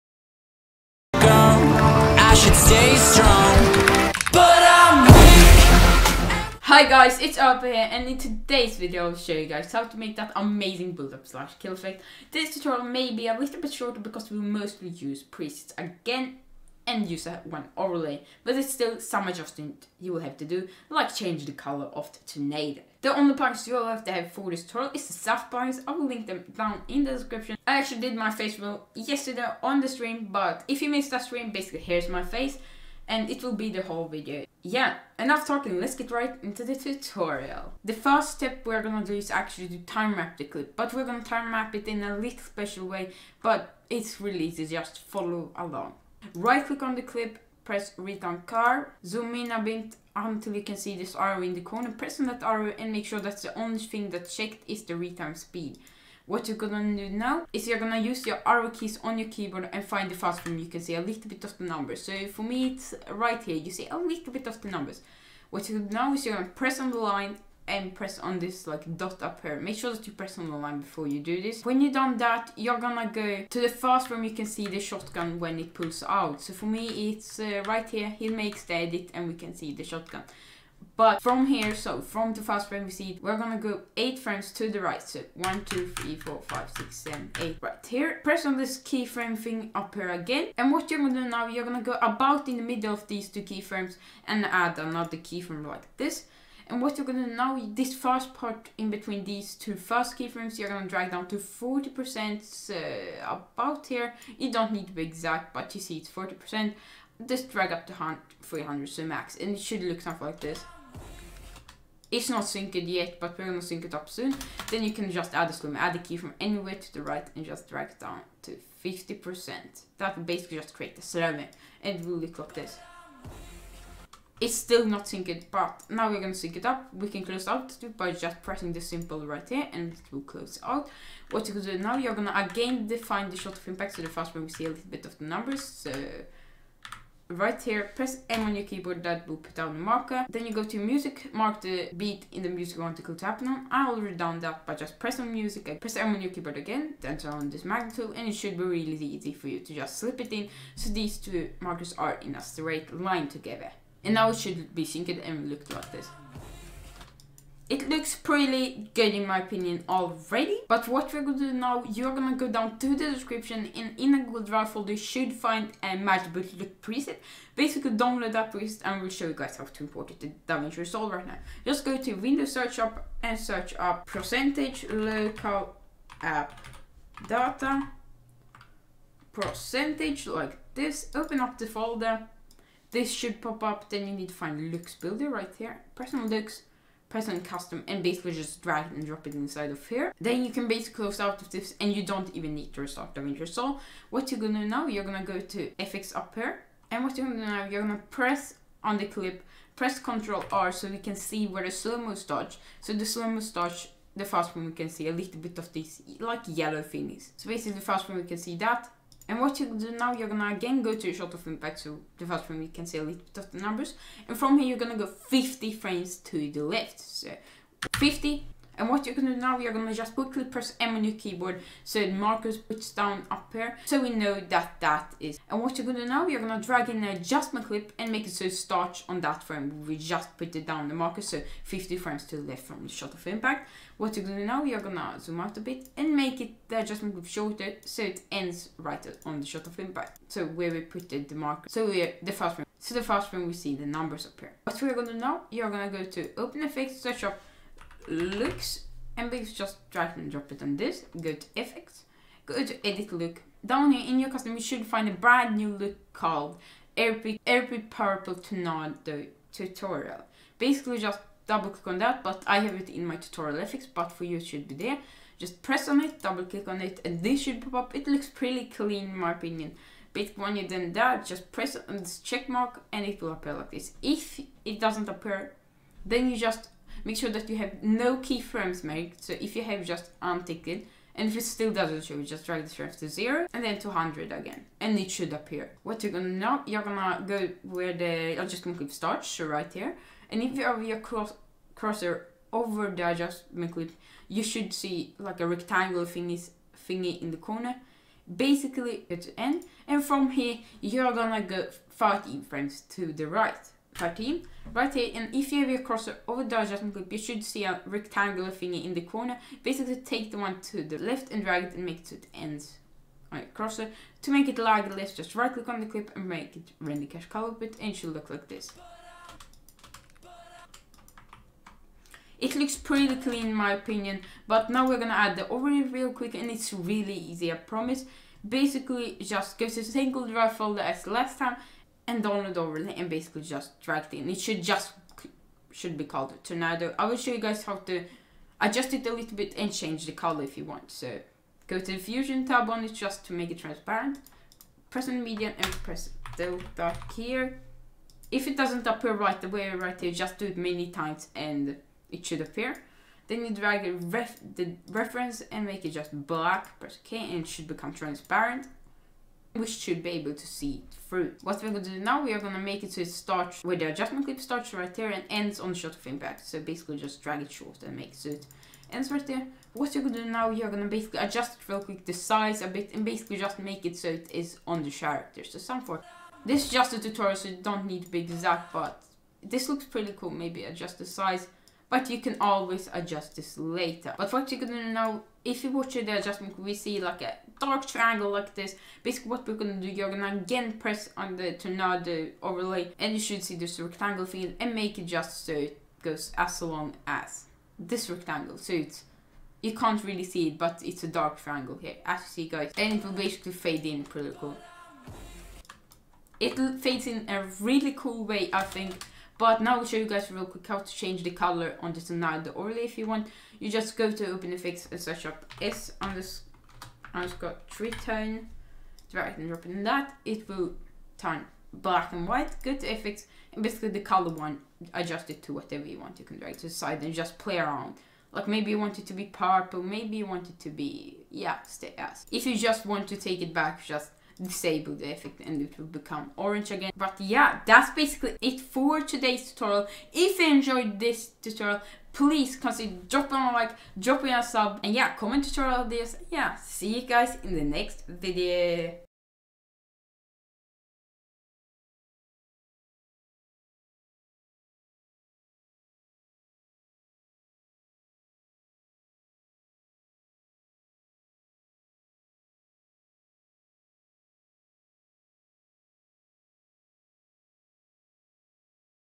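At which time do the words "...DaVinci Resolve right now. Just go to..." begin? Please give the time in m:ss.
2:50.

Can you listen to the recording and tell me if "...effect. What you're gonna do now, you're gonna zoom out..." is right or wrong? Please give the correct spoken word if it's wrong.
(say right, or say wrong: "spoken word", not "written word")
wrong: "impact", not "effect".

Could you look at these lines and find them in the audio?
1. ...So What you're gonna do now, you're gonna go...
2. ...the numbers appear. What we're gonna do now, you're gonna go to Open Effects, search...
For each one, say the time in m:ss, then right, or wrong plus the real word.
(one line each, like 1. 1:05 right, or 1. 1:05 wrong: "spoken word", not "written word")
1. 3:13 right
2. 4:03 right.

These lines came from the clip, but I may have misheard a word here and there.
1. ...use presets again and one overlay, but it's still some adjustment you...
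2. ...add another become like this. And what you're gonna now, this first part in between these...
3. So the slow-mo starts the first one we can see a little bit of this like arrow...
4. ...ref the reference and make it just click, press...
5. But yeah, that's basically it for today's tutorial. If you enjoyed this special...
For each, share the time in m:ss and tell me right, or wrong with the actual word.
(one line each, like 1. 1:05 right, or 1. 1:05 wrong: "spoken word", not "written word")
1. 0:14 right
2. 1:34 wrong: "keyframe", not "become"
3. 3:22 wrong: "yellow", not "arrow"
4. 5:54 wrong: "black", not "click"
5. 7:16 wrong: "tutorial", not "special".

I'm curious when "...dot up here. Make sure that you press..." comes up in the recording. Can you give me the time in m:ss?
1:08.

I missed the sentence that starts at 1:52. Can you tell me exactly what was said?
It's not synced yet, but we're gonna sync it up soon.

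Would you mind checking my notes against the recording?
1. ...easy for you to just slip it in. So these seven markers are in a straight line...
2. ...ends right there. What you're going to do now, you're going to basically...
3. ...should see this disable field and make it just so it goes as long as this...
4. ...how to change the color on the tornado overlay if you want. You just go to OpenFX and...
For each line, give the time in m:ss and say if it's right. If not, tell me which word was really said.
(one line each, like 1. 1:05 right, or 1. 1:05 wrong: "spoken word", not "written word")
1. 2:29 wrong: "two", not "seven"
2. 6:08 right
3. 6:33 wrong: "rectangle", not "disable"
4. 6:50 right.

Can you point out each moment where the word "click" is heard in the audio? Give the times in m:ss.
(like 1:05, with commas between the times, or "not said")
0:46, 4:21, 4:26, 5:15.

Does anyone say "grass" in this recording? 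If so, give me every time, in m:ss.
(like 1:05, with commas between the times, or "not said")
not said.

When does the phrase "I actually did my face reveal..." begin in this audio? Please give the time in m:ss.
0:27.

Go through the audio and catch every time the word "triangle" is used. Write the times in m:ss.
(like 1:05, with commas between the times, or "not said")
6:27, 6:41.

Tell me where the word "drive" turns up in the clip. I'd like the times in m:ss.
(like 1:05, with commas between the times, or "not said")
2:44, 5:30.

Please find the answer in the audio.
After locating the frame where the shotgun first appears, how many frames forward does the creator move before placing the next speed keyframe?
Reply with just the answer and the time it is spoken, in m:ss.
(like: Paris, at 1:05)
8, at 1:23.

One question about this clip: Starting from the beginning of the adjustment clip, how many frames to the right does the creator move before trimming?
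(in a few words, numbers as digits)
13.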